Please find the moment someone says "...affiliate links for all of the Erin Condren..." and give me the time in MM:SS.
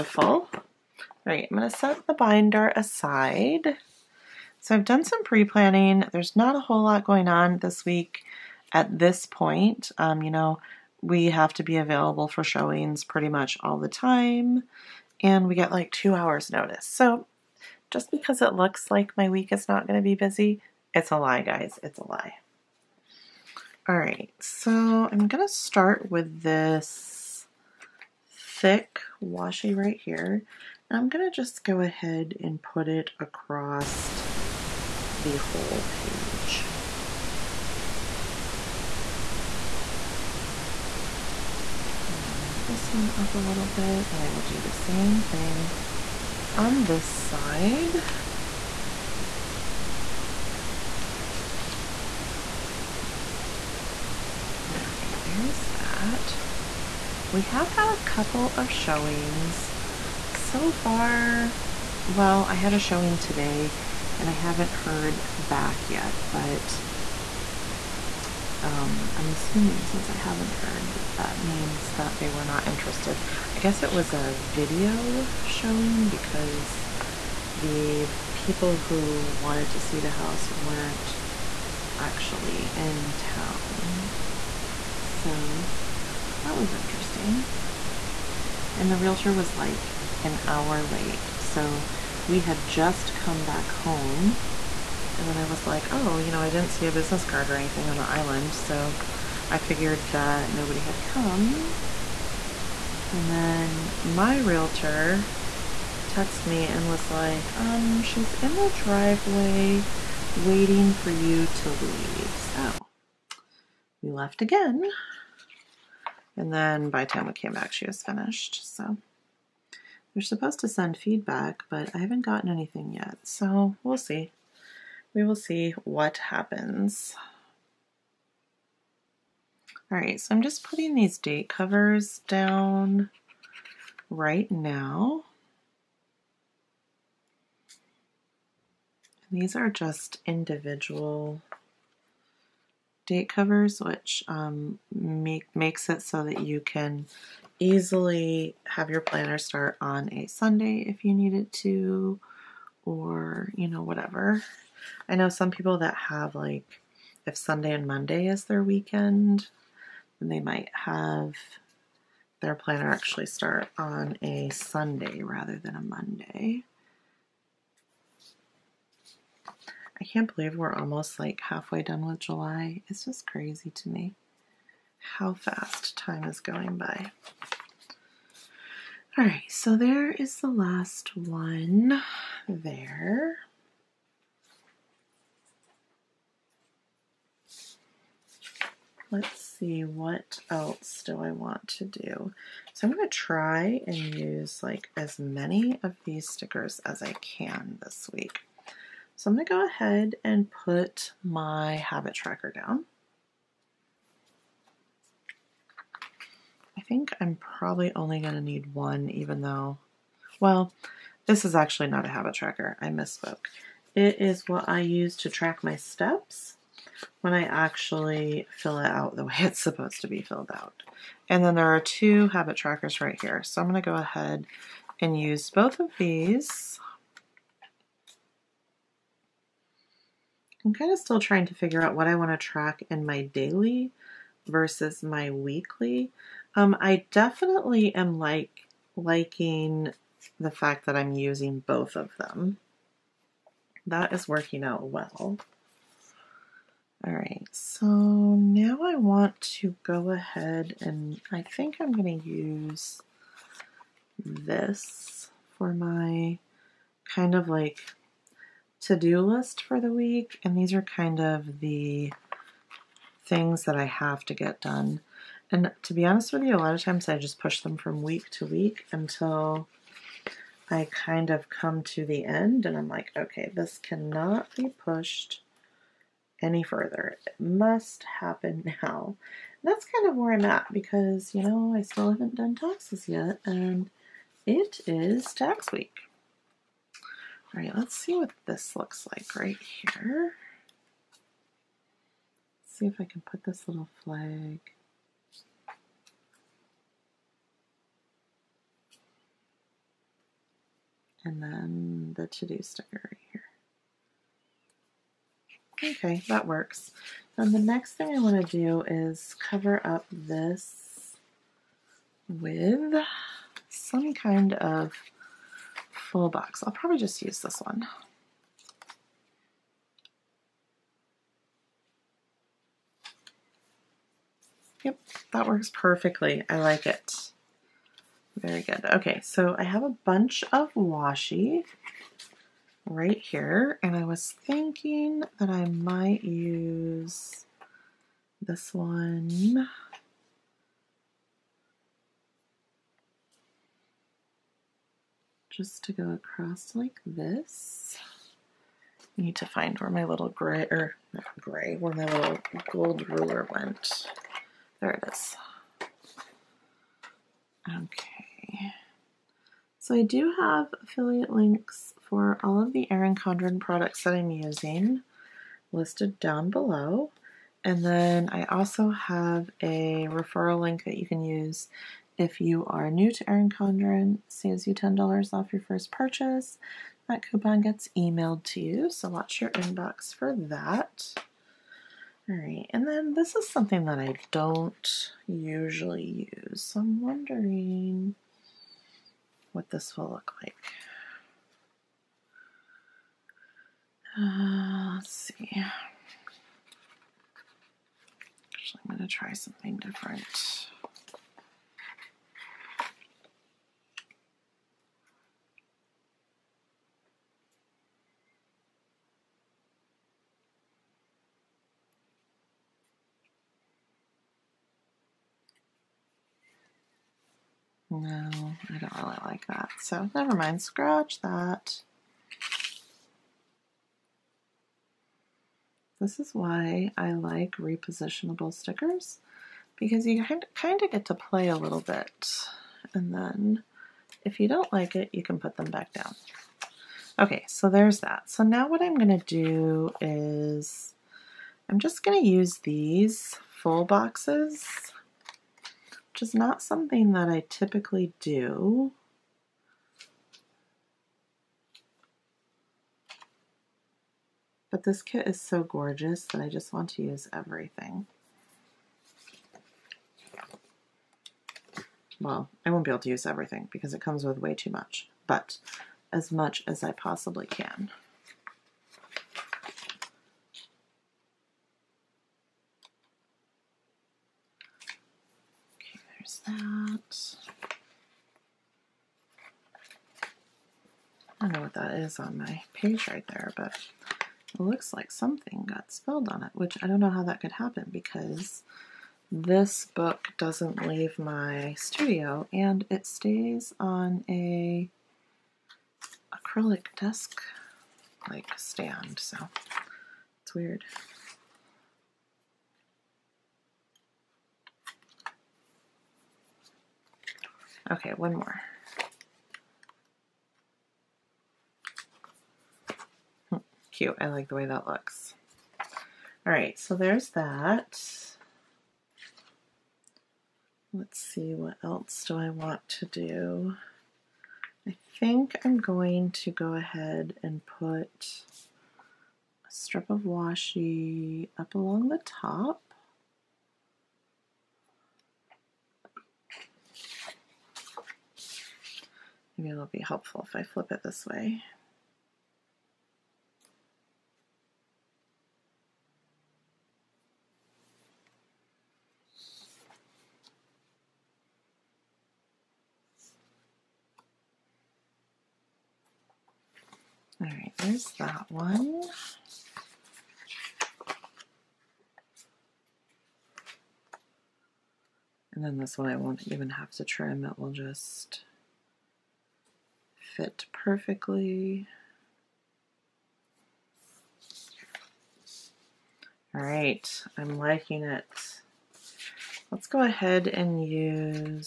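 06:00.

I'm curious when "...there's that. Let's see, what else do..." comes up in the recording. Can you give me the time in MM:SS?
08:36.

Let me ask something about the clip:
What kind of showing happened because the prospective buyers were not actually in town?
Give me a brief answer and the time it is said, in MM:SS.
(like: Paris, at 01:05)
video showing, at 01:14.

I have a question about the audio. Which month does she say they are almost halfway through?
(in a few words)
July.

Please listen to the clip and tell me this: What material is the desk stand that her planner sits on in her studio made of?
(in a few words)
acrylic.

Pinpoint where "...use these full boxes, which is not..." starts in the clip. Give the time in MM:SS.
07:22.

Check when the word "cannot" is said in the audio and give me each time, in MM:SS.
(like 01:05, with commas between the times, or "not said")
04:33.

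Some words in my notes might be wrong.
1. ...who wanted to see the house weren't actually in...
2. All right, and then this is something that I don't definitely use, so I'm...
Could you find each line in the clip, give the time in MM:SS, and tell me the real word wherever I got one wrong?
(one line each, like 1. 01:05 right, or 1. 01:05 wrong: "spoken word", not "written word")
1. 01:18 right
2. 06:22 wrong: "usually", not "definitely".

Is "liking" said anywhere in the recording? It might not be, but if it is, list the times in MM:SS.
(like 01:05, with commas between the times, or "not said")
03:58, 09:37.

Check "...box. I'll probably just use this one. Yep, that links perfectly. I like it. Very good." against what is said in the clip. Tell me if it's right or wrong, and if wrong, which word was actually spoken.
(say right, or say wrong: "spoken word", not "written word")
wrong: "works", not "links".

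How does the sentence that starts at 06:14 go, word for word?
Saves you $10 off your first purchase.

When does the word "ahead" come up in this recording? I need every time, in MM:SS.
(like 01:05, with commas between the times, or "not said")
00:31, 03:19, 03:43, 04:10, 08:46, 09:40.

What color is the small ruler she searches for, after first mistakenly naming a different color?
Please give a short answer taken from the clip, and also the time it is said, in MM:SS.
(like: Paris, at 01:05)
gold, at 05:52.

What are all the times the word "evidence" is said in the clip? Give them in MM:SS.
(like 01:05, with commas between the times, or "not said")
not said.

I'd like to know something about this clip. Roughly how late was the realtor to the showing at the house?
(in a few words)
an hour.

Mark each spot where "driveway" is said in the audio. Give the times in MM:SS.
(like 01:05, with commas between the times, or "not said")
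01:48.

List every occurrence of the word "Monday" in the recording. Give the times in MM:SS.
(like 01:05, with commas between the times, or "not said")
02:37, 02:45.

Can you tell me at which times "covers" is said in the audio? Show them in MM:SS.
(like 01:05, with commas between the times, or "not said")
02:11, 02:23, 05:09.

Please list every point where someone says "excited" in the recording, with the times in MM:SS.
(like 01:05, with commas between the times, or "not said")
not said.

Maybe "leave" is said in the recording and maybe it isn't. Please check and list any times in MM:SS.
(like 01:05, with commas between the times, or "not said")
01:51, 08:10.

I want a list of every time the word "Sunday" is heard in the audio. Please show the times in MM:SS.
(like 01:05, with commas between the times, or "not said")
02:30, 02:37, 02:44.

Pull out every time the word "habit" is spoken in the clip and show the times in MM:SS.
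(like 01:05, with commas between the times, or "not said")
03:21, 03:32, 03:42.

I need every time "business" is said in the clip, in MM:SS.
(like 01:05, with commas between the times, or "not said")
01:36.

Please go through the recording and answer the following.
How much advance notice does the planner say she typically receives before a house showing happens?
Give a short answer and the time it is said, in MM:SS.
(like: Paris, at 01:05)
2 hours, at 00:15.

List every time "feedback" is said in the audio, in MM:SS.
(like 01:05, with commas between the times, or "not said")
02:00.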